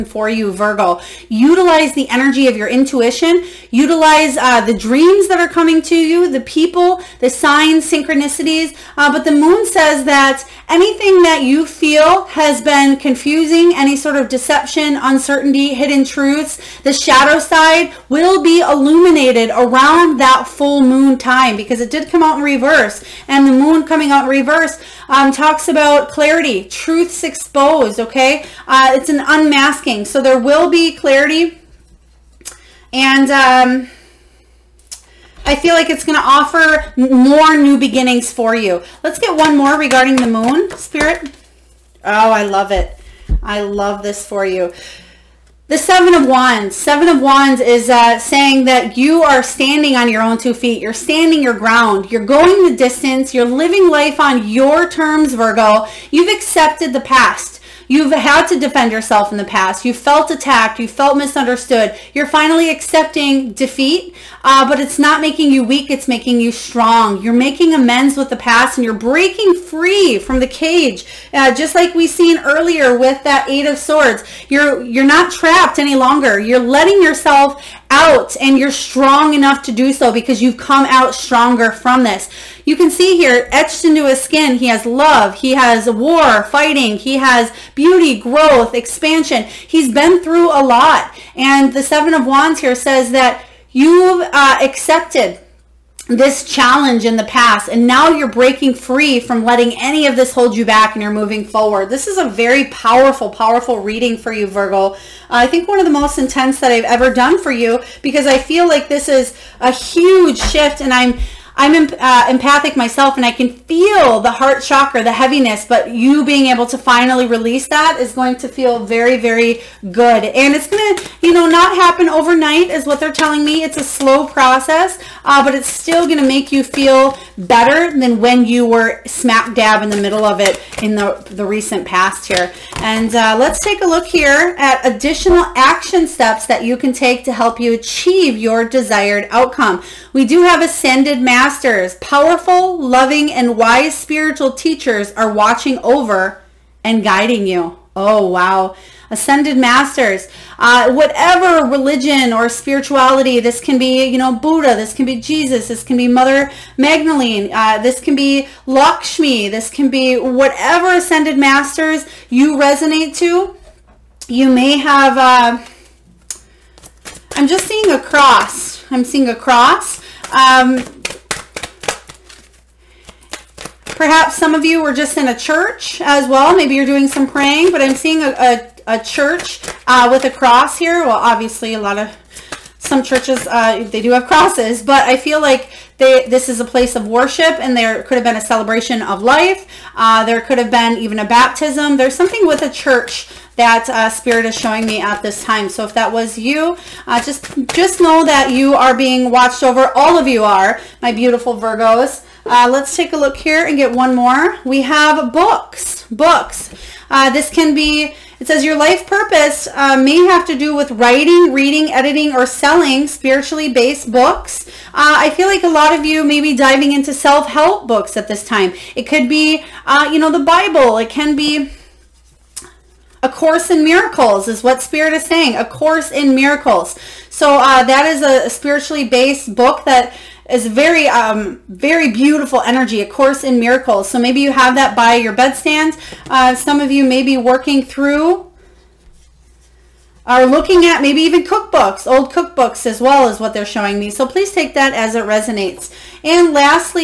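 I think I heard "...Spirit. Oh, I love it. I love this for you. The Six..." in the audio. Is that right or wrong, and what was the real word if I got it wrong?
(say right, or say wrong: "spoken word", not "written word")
wrong: "Seven", not "Six".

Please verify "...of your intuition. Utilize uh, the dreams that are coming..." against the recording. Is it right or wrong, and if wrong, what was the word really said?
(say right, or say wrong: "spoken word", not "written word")
right.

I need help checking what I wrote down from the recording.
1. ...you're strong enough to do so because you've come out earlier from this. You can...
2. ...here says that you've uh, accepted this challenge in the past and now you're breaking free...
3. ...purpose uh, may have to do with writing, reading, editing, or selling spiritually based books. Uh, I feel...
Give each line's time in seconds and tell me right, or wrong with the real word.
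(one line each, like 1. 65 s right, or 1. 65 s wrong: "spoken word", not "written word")
1. 78 s wrong: "stronger", not "earlier"
2. 92 s right
3. 209 s right.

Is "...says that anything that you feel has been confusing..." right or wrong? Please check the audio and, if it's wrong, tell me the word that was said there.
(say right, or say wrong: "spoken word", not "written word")
right.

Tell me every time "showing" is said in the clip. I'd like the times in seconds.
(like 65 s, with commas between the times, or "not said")
194 s, 243 s.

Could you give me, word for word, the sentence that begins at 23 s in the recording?
And the moon coming out in reverse um, talks about clarity, truths exposed, okay?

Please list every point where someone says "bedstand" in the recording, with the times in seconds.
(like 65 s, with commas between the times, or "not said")
235 s.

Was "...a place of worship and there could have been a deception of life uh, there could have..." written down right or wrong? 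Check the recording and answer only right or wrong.
wrong.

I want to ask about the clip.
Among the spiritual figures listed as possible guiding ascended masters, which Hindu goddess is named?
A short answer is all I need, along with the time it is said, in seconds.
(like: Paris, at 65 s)
Lakshmi, at 158 s.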